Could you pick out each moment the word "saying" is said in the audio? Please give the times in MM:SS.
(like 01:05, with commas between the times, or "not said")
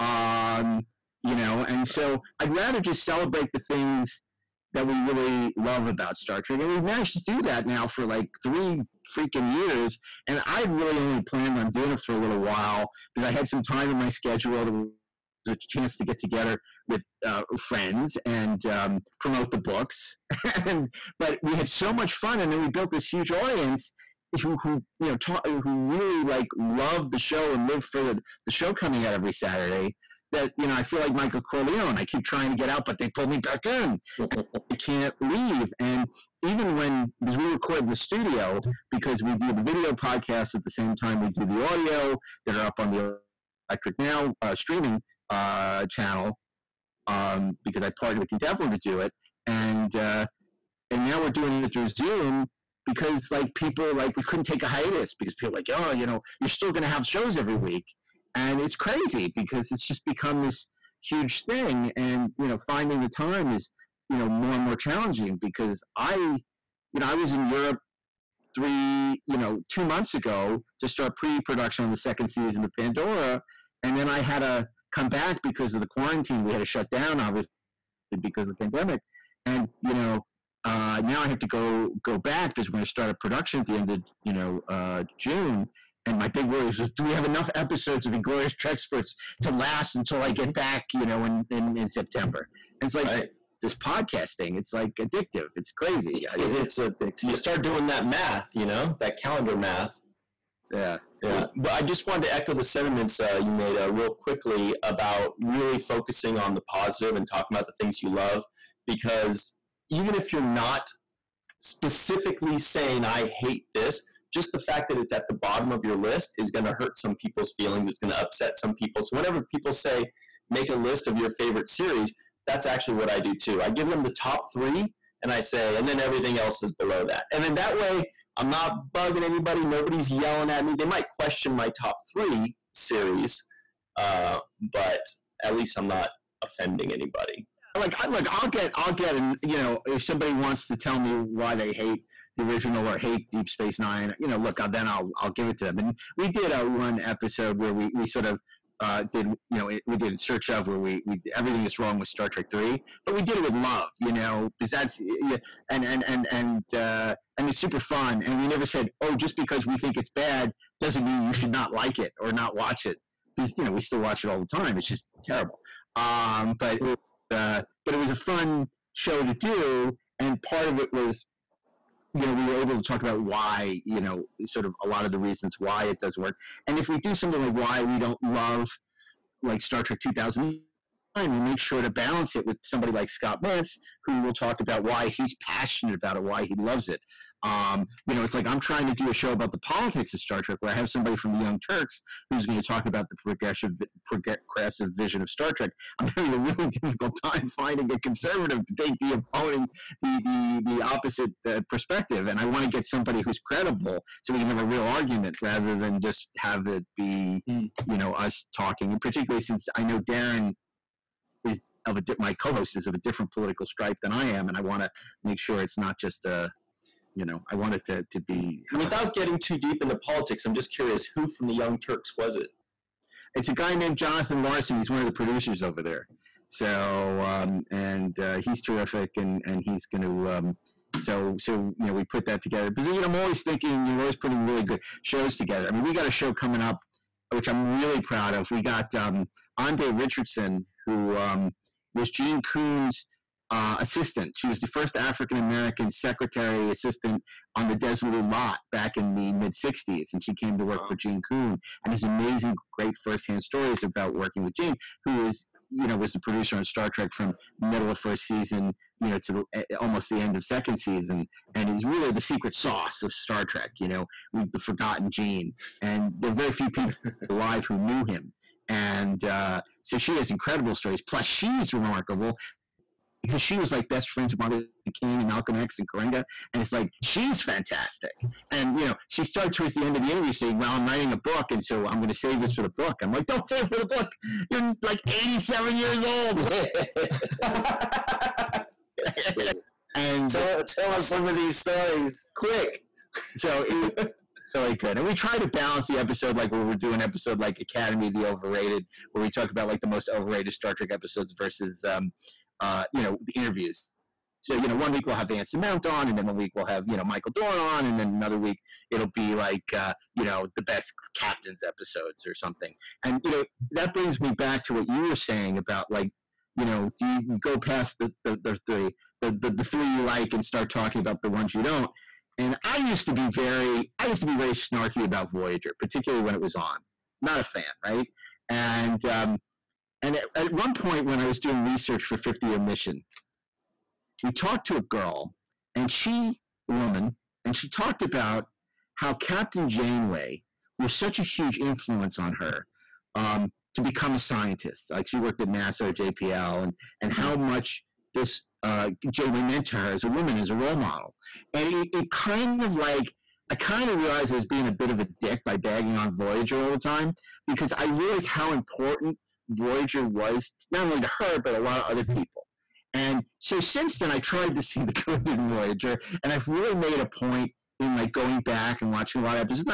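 01:52, 04:40, 05:15.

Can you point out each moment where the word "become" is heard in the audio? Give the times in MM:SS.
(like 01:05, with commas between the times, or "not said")
01:00, 05:43.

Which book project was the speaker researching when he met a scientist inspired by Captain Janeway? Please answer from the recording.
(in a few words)
50 year mission.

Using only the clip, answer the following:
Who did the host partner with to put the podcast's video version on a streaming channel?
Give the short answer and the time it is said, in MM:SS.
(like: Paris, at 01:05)
Dean Devlin, at 00:48.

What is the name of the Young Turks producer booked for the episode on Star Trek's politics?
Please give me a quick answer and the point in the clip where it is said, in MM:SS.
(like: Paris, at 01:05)
Jonathan Larson, at 03:43.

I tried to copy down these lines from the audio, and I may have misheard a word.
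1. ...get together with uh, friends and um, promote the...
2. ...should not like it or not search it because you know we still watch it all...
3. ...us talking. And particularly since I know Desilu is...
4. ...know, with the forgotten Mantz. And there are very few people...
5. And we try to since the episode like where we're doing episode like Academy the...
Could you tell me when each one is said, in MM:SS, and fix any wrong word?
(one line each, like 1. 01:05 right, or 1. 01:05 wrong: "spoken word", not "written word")
1. 00:16 right
2. 02:41 wrong: "watch", not "search"
3. 03:28 wrong: "Daren", not "Desilu"
4. 04:23 wrong: "Gene", not "Mantz"
5. 04:54 wrong: "balance", not "since".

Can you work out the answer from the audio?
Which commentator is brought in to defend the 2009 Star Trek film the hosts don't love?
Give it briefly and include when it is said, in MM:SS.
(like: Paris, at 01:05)
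Scott Mantz, at 03:03.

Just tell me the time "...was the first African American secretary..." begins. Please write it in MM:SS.
04:04.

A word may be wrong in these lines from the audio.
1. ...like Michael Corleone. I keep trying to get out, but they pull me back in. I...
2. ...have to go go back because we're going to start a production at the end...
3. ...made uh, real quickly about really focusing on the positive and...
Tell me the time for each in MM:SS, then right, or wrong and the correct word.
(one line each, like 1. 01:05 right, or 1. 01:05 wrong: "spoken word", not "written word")
1. 00:30 right
2. 01:21 right
3. 01:43 right.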